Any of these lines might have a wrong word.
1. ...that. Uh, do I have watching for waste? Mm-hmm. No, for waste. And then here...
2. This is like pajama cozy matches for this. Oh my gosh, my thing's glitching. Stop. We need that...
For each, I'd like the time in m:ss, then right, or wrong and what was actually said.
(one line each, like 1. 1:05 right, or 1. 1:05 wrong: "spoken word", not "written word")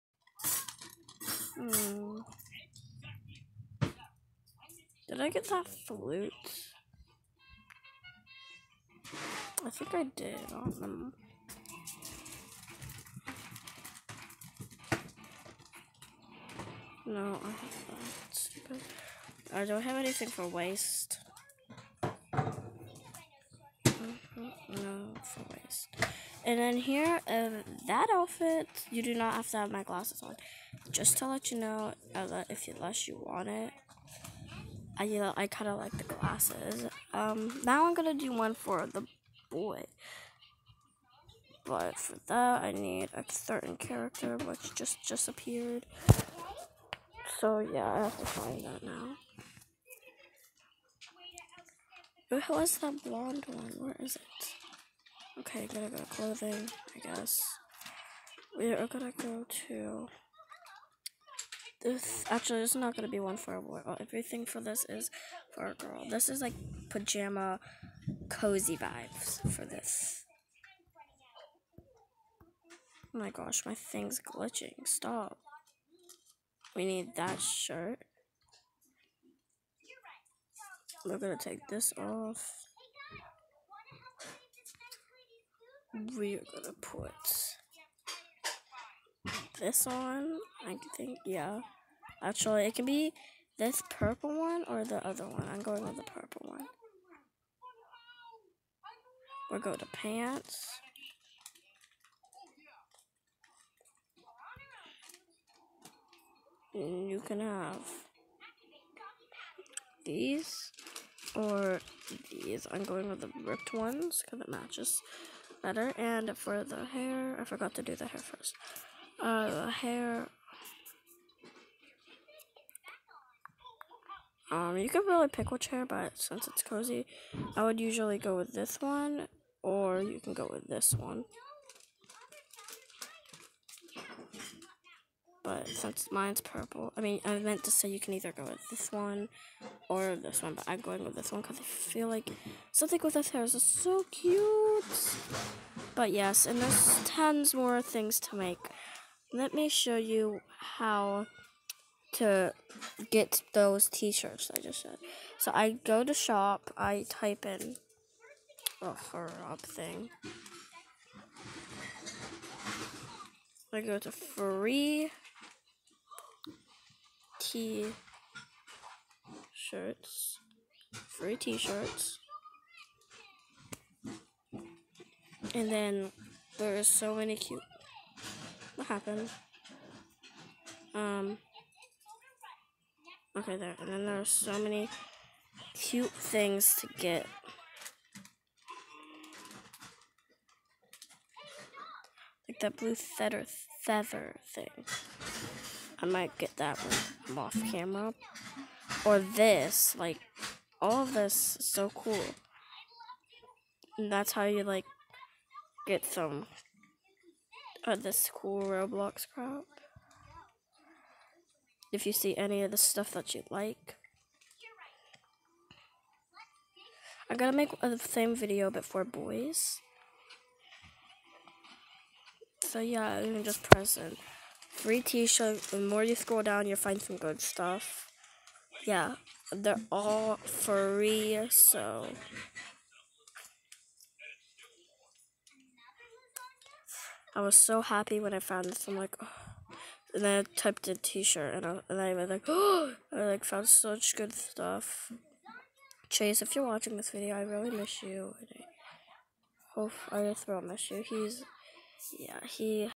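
1. 0:17 wrong: "anything", not "watching"
2. 1:06 wrong: "vibes", not "matches".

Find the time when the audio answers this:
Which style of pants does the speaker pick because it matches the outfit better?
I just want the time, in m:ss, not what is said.
1:52.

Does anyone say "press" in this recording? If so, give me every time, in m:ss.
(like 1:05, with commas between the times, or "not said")
3:43.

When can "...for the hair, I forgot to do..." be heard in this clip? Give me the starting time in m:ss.
1:56.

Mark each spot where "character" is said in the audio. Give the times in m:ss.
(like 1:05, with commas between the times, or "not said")
0:43.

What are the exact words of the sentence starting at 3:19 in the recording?
Like, all of this is so cool.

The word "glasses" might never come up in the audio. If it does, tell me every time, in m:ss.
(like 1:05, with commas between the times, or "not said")
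0:29, 0:36.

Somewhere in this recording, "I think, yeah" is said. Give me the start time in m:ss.
1:30.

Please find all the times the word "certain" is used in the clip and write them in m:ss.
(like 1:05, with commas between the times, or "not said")
0:43.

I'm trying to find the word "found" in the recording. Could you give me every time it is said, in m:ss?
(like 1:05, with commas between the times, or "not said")
3:58, 4:03.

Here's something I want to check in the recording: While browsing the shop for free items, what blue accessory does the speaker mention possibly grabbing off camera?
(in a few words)
Blue feather.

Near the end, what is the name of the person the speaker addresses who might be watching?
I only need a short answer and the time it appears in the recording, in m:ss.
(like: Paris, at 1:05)
Chase, at 4:06.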